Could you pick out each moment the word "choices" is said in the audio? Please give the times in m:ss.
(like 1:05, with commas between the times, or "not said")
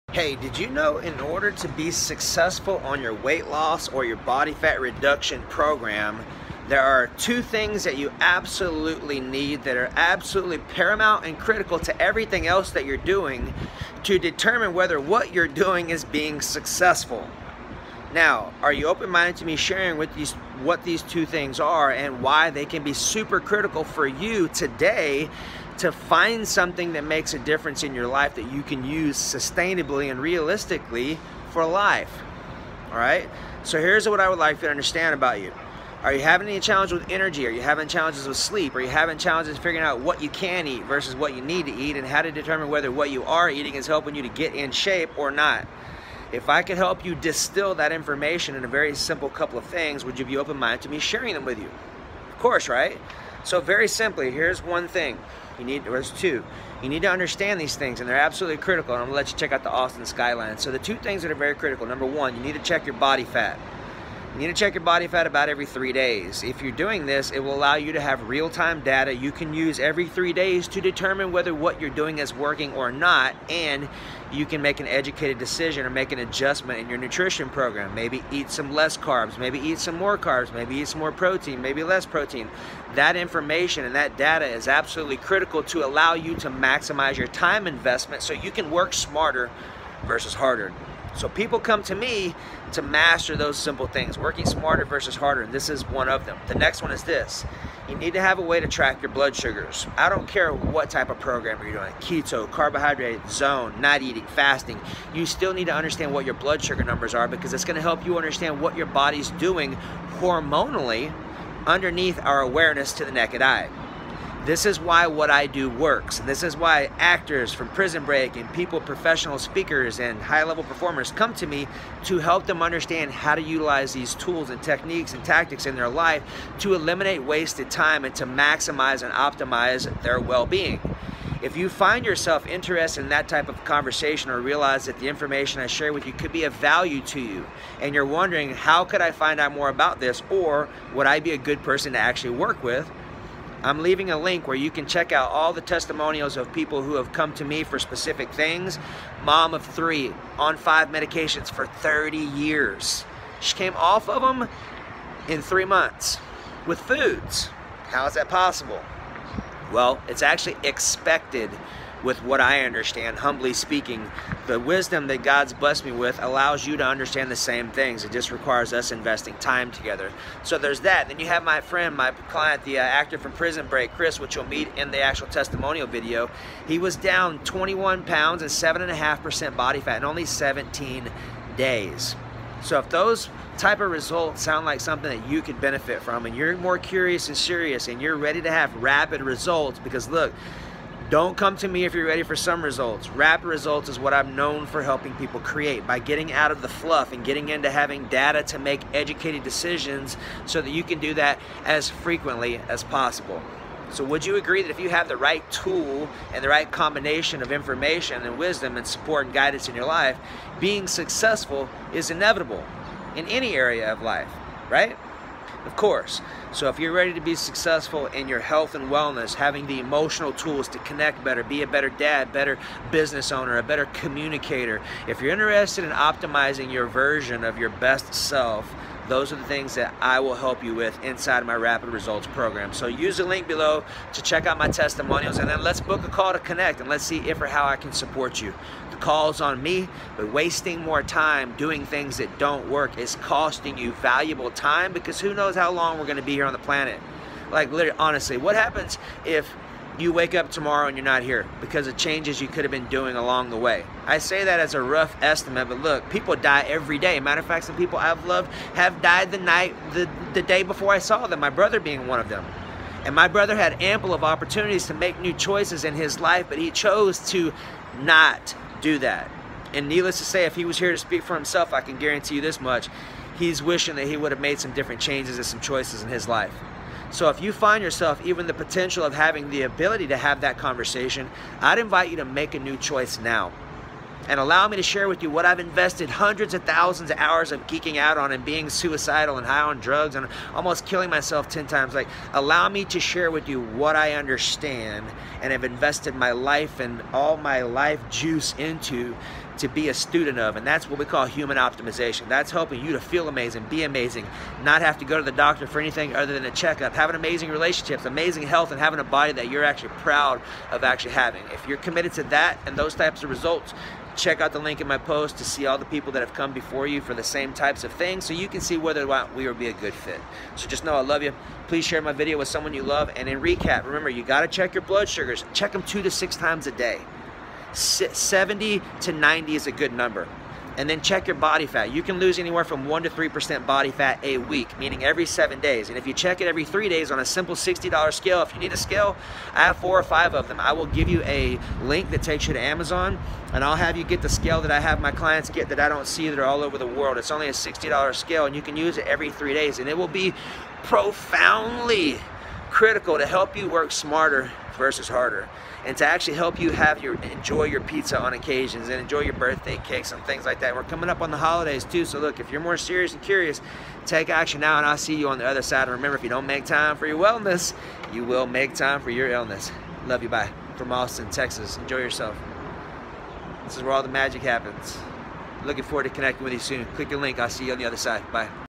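4:25, 4:35, 4:42.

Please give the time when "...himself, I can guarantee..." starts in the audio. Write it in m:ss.
4:31.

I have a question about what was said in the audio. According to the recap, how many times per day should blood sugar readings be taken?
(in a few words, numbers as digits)
2 to 6.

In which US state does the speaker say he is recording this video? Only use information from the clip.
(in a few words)
Texas.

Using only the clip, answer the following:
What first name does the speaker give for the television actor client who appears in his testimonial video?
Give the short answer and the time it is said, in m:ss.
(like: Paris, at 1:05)
Chris, at 2:53.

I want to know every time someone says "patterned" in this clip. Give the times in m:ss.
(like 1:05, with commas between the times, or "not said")
not said.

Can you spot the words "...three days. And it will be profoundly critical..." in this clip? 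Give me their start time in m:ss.
5:49.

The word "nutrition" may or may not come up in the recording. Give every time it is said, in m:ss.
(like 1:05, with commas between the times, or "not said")
1:16.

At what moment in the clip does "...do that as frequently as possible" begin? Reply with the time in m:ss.
3:21.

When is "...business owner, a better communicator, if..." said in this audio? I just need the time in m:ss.
3:42.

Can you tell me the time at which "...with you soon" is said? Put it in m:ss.
6:16.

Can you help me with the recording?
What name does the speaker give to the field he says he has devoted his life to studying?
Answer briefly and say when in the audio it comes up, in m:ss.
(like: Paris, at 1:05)
human optimization, at 5:01.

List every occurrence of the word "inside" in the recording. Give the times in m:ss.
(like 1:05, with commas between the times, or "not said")
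3:51.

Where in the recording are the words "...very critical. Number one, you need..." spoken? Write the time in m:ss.
1:01.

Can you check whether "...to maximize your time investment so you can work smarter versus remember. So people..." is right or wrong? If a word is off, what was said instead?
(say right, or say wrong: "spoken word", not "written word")
wrong: "harder", not "remember".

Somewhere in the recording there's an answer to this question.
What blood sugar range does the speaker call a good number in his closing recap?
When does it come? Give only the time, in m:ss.
5:27.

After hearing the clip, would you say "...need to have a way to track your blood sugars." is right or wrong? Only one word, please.
right.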